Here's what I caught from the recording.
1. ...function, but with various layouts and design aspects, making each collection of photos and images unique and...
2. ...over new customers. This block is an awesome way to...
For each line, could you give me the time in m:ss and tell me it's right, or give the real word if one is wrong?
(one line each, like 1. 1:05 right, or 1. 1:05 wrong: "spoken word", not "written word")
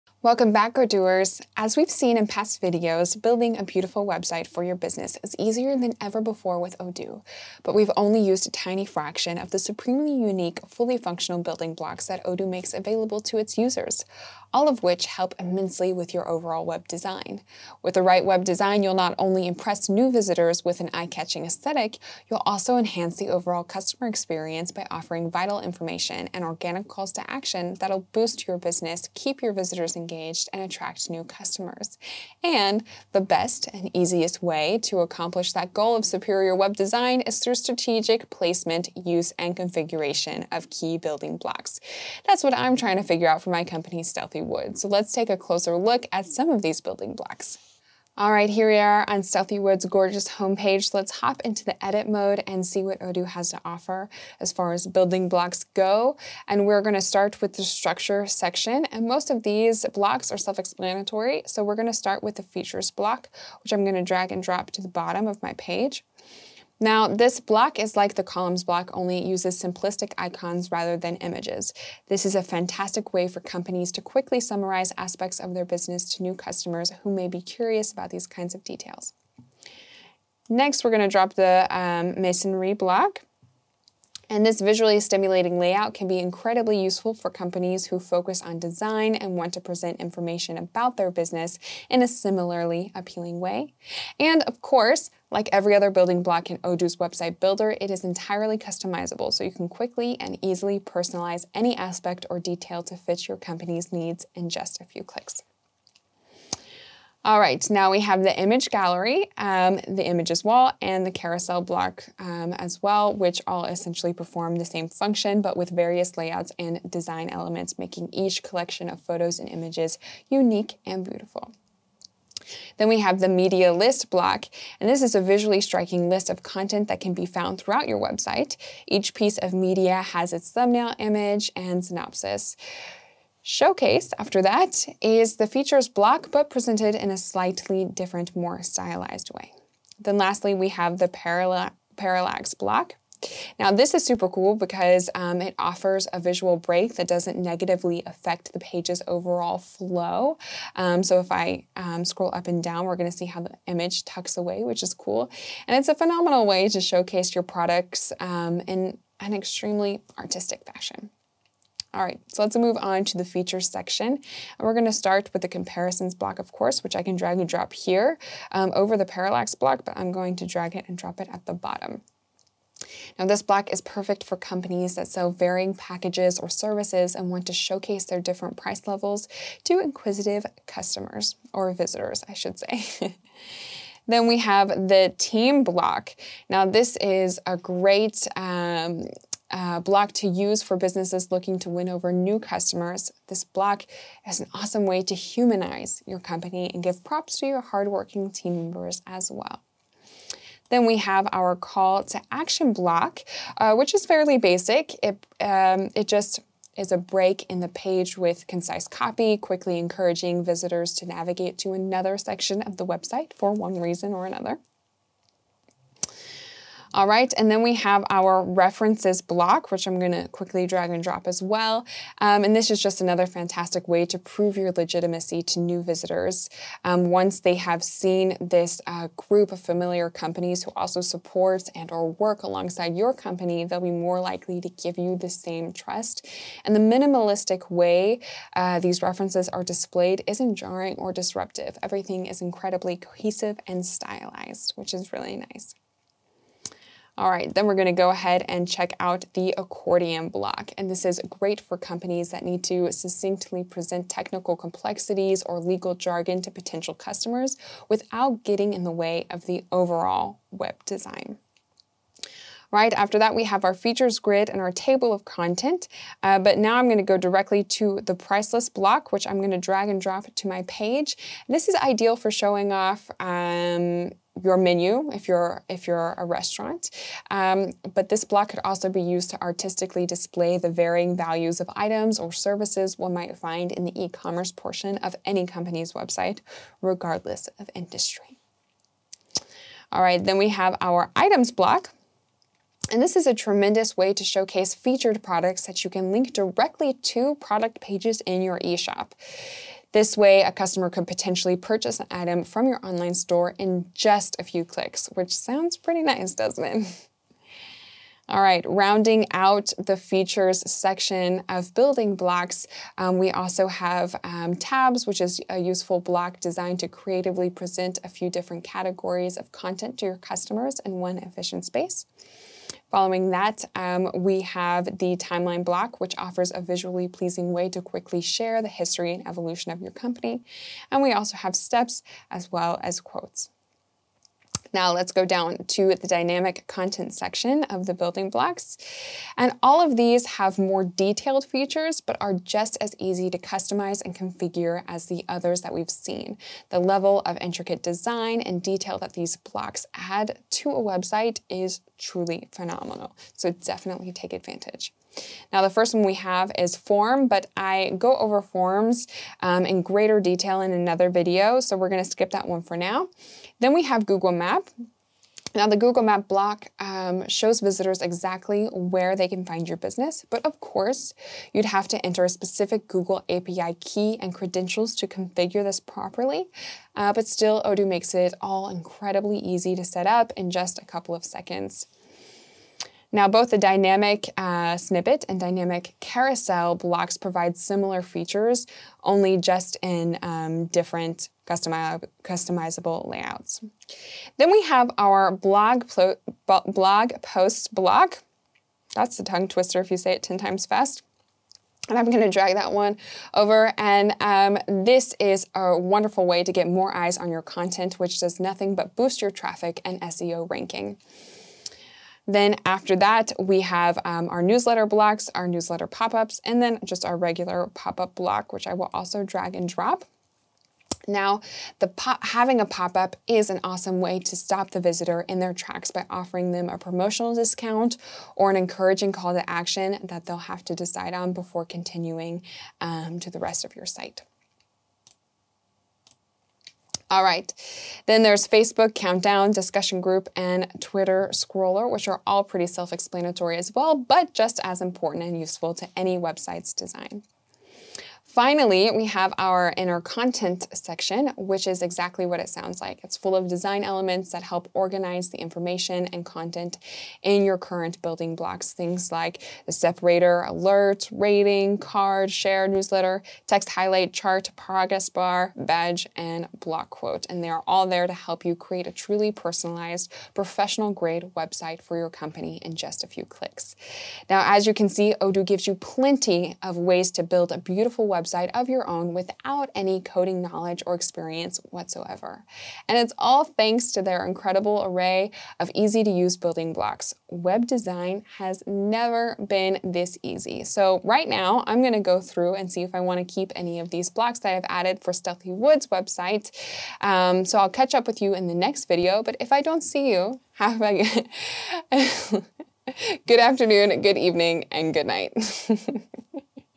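1. 1:54 wrong: "elements", not "aspects"
2. 3:11 right.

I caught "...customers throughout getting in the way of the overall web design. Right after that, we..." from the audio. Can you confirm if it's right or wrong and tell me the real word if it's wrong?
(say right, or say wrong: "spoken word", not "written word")
wrong: "without", not "throughout".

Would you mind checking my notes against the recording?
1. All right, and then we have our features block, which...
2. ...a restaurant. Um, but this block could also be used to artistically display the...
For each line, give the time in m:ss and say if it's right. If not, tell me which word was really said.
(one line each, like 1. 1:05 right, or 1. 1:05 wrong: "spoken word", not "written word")
1. 3:36 wrong: "references", not "features"
2. 4:36 right.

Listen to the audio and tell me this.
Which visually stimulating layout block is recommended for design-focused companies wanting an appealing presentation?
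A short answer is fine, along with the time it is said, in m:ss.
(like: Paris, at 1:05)
Masonry block, at 1:22.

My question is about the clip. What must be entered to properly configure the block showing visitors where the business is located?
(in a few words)
Google API key.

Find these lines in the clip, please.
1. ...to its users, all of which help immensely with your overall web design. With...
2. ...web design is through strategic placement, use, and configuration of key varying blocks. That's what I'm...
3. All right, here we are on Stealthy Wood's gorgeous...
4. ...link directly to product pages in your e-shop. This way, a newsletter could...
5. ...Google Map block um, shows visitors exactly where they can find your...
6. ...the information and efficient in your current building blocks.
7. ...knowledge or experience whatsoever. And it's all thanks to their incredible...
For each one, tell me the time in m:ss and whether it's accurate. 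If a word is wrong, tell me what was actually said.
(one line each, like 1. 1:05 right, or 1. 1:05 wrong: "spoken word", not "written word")
1. 0:13 right
2. 0:36 wrong: "building", not "varying"
3. 0:48 right
4. 4:56 wrong: "customer", not "newsletter"
5. 6:05 right
6. 7:35 wrong: "content", not "efficient"
7. 8:00 right.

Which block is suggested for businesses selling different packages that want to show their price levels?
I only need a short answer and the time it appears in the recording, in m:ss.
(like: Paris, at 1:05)
Comparisons block, at 2:45.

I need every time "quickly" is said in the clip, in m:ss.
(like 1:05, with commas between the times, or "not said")
1:14, 1:39, 3:29, 3:40, 5:27.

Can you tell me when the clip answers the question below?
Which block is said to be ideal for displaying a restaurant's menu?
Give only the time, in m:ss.
4:28.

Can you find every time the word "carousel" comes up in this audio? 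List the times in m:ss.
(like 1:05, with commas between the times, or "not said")
1:51, 6:25.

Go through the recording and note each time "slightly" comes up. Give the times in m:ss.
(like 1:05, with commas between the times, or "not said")
2:17.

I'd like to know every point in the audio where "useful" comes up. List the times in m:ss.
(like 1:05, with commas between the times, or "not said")
1:26, 5:15, 7:25.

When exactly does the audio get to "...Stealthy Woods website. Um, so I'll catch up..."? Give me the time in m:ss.
8:15.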